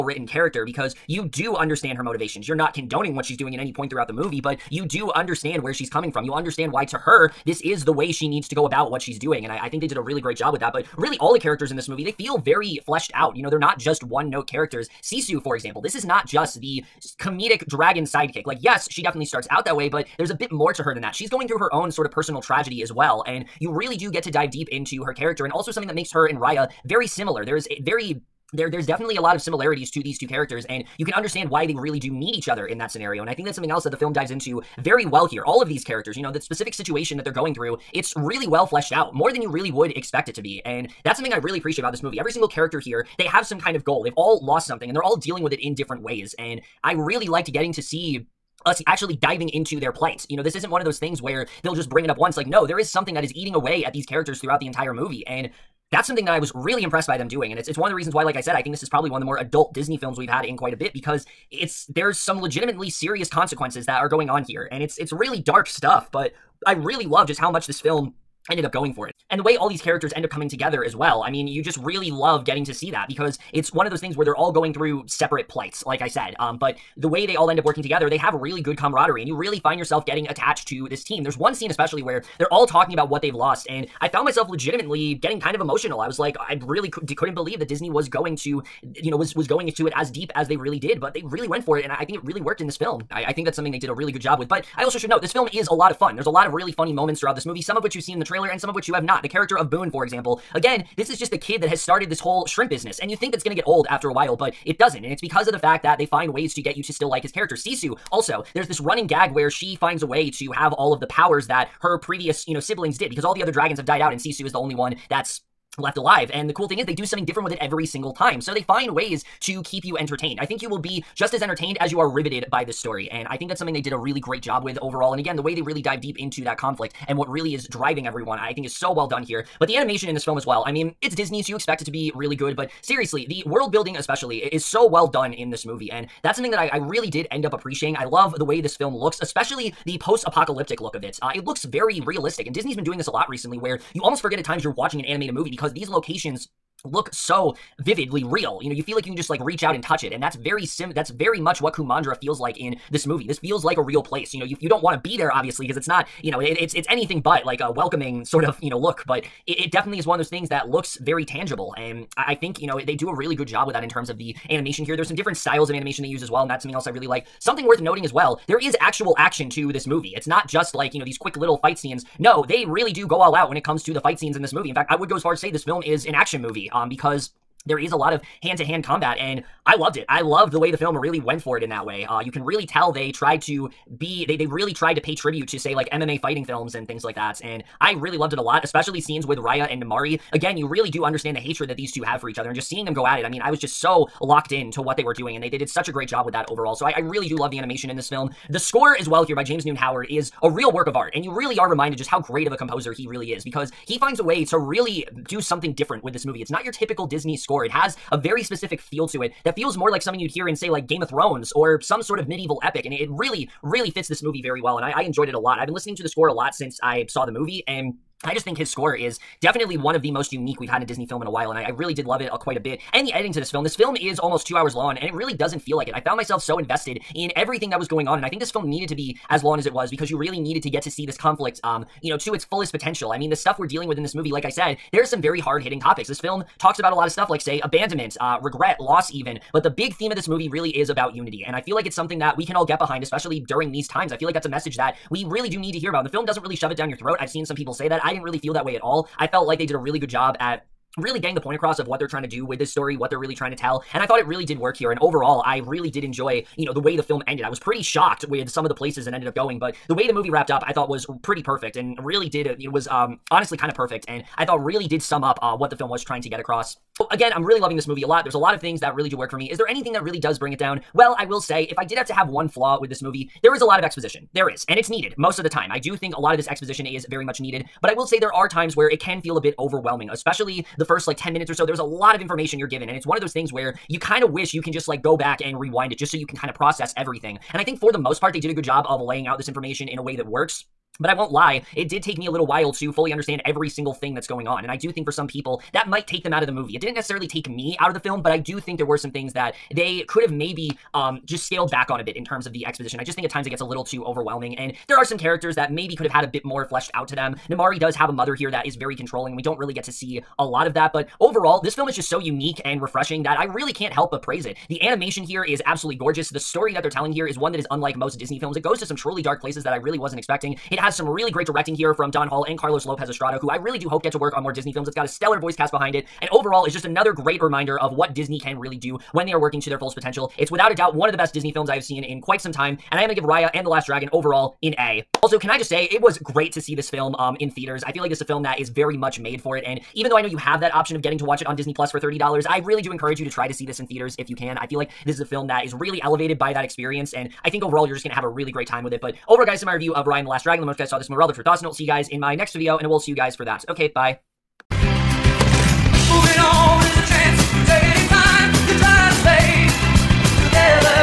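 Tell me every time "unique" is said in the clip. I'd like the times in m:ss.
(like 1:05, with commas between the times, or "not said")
3:40, 5:12.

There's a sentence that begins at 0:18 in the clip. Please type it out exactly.
Like, yes, she definitely starts out that way, but there's a bit more to her than that.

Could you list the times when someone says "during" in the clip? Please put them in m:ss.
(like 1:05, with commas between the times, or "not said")
4:03.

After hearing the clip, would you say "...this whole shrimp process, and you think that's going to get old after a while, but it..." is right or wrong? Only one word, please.
wrong.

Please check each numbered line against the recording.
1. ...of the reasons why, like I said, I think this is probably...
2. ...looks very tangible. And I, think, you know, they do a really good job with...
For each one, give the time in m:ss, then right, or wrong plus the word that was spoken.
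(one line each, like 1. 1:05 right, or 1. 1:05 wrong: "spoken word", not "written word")
1. 0:57 right
2. 2:40 right.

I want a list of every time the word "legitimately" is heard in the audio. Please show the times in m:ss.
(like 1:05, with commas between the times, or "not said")
1:02, 1:24.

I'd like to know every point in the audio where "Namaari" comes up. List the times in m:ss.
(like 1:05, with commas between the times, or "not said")
3:09, 5:07.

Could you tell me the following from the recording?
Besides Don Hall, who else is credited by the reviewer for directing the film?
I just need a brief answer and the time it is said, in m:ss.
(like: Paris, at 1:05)
Carlos Lopez Estrada, at 5:22.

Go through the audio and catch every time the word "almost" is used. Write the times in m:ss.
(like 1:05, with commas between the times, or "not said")
2:24, 3:44.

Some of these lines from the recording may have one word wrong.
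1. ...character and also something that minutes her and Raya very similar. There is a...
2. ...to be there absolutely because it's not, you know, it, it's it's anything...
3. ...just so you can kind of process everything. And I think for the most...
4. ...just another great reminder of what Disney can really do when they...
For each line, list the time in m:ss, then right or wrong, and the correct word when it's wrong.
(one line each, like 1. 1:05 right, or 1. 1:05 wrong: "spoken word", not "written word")
1. 0:25 wrong: "makes", not "minutes"
2. 2:34 wrong: "obviously", not "absolutely"
3. 4:45 right
4. 5:26 right.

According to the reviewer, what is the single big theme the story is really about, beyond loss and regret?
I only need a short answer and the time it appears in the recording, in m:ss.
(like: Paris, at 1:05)
unity, at 4:01.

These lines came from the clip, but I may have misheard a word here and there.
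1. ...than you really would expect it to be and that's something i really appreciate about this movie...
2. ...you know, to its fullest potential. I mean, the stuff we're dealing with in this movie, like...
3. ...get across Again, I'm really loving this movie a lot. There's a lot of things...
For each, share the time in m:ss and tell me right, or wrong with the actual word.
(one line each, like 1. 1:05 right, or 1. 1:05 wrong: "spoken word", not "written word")
1. 0:39 right
2. 3:52 right
3. 4:26 right.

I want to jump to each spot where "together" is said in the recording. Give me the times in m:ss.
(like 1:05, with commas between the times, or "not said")
1:10, 1:17.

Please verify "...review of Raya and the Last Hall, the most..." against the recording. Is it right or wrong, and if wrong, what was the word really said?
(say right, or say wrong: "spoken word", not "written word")
wrong: "Dragon", not "Hall".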